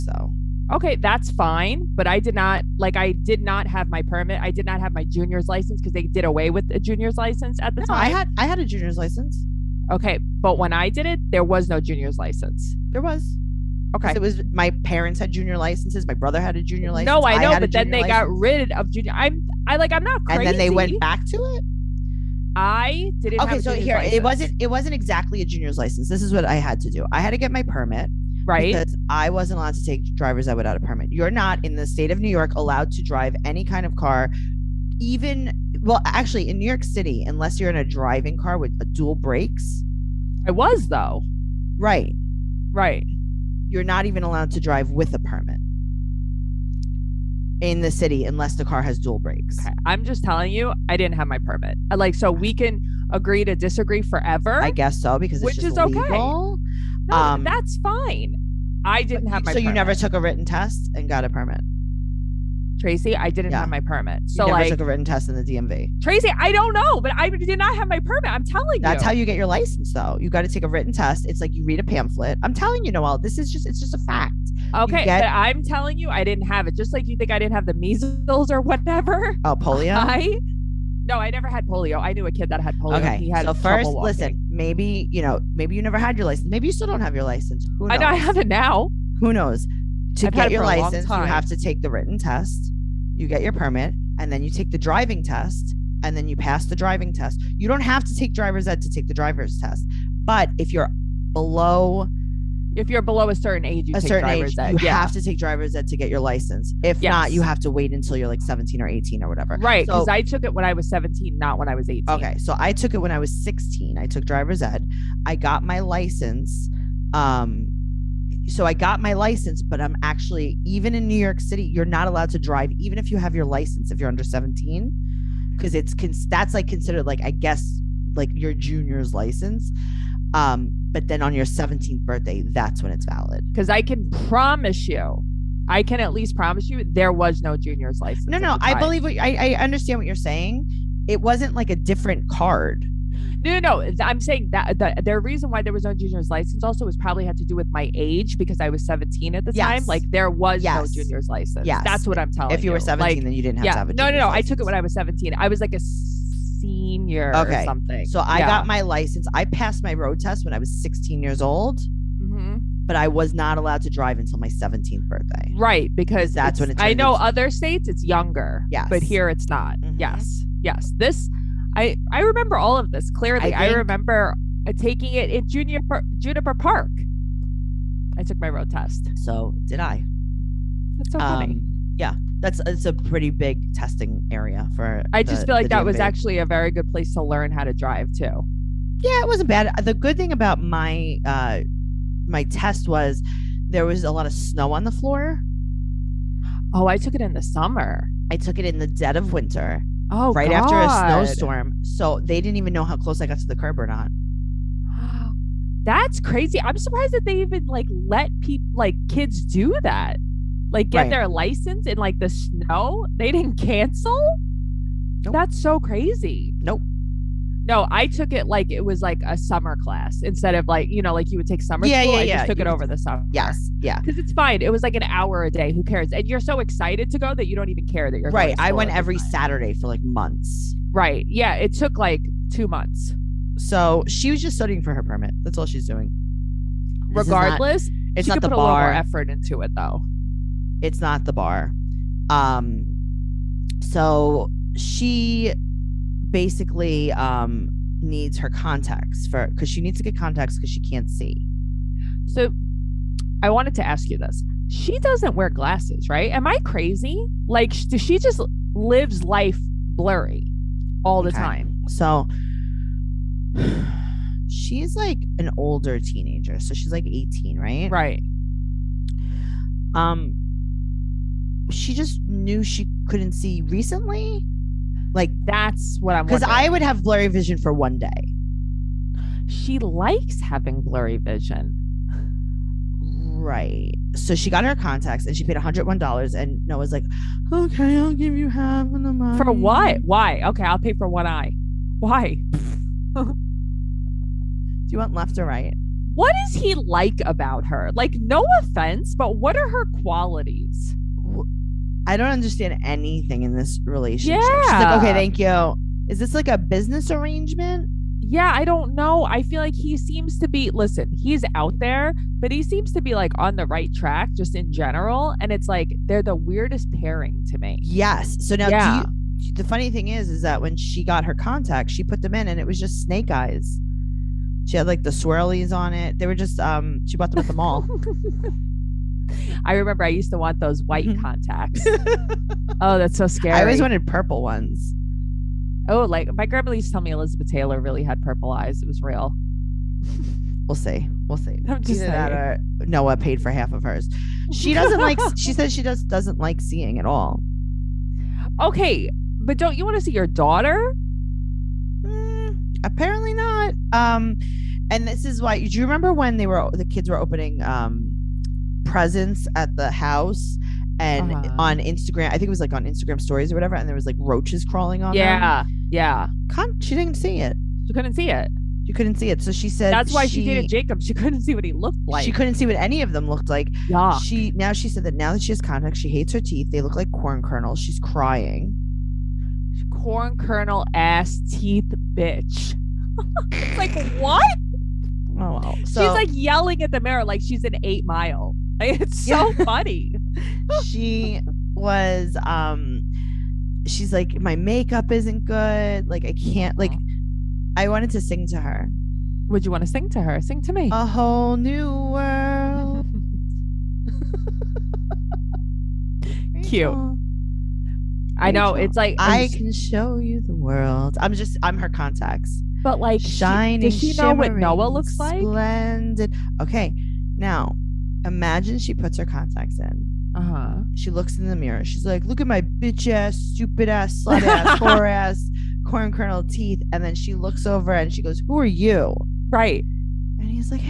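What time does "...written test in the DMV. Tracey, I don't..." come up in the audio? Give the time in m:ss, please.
1:04.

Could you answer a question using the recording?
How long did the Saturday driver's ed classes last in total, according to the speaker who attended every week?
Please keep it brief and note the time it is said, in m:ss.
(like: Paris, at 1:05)
2 months, at 3:52.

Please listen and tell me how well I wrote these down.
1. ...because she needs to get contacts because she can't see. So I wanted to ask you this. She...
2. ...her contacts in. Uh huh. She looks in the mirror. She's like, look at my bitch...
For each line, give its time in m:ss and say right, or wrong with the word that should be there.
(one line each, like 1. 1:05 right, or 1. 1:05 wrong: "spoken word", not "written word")
1. 4:09 right
2. 6:59 right.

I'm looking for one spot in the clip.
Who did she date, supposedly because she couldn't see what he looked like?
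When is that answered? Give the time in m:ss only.
6:10.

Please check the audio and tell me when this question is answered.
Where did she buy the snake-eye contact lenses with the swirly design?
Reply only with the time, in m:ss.
5:27.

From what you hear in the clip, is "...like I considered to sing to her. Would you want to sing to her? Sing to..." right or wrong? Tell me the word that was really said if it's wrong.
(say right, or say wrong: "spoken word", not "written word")
wrong: "wanted", not "considered".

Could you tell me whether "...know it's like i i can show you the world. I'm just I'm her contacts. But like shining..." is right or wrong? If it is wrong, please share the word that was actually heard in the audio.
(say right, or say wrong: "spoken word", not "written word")
right.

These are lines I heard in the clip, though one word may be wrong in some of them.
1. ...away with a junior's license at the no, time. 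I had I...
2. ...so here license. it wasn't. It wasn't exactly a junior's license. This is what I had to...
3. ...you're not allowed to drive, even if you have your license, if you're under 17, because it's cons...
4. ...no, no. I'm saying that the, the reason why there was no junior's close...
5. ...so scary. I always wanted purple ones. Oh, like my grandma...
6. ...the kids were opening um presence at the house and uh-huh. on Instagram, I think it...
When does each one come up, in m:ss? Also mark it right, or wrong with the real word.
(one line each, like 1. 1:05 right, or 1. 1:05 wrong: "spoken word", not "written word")
1. 0:06 right
2. 0:23 right
3. 2:01 right
4. 2:23 wrong: "license", not "close"
5. 5:33 right
6. 5:56 right.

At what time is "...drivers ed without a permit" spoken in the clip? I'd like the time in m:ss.
0:30.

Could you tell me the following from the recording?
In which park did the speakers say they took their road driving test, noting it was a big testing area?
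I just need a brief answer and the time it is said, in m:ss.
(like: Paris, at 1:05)
Juniper Park, at 2:56.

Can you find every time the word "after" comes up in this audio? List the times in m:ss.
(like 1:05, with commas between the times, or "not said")
3:20.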